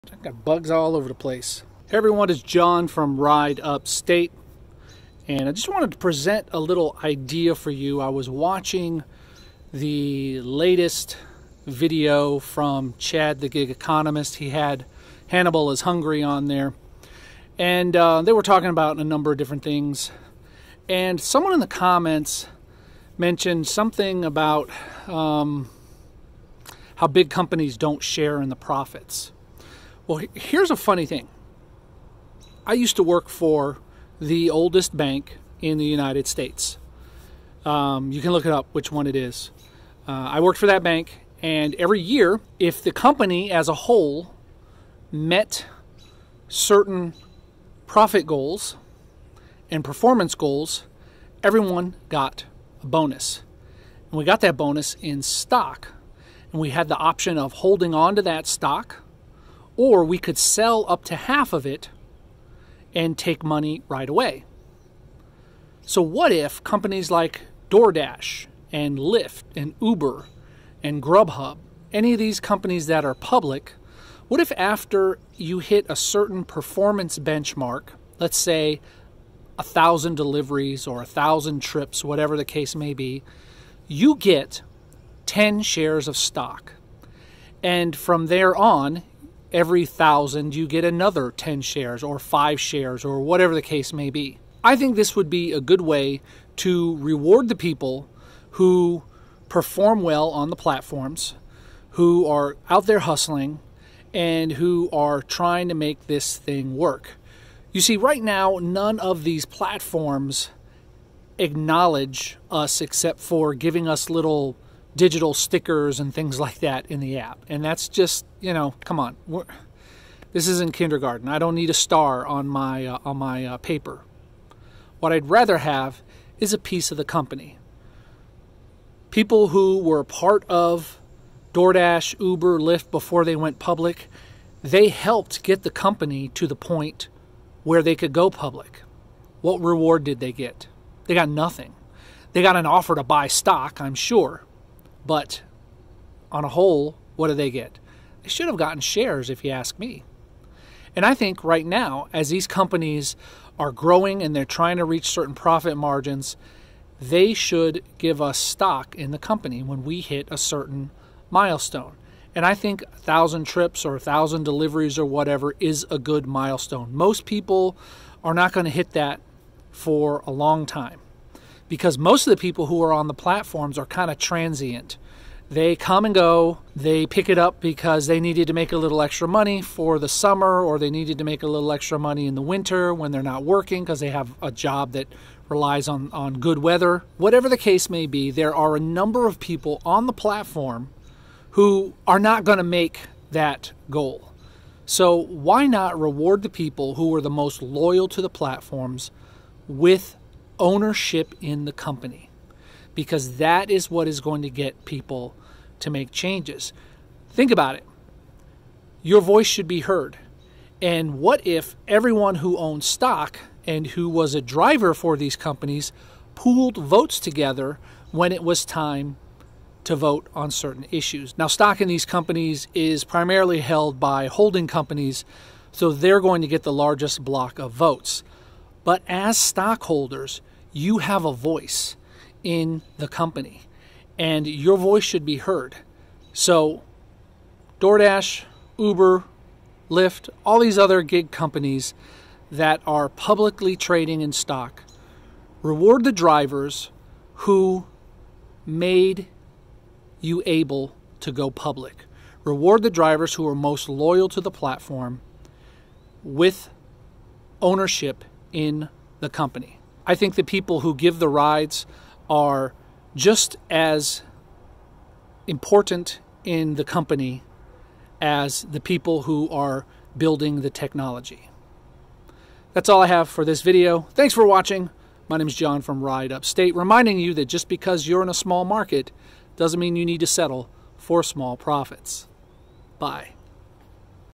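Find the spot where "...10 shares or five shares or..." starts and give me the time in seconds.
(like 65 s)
91 s.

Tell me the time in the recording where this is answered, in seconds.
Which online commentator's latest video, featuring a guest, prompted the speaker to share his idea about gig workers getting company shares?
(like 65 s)
12 s.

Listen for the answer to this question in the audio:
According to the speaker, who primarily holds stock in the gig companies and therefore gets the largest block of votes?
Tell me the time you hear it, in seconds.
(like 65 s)
224 s.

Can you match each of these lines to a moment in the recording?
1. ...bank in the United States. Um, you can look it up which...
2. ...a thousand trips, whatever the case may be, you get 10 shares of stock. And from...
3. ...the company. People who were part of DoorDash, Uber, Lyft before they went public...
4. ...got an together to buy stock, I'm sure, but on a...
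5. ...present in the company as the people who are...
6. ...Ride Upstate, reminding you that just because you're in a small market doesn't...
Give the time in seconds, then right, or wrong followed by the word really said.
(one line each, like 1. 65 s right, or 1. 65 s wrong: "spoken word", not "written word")
1. 34 s right
2. 81 s right
3. 126 s right
4. 142 s wrong: "offer", not "together"
5. 265 s wrong: "important", not "present"
6. 276 s right.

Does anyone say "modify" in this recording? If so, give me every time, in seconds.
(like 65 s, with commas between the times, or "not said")
not said.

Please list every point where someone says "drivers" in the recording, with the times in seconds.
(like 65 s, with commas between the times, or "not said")
214 s, 246 s, 252 s.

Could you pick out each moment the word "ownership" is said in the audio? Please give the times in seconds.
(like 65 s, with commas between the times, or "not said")
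200 s, 257 s.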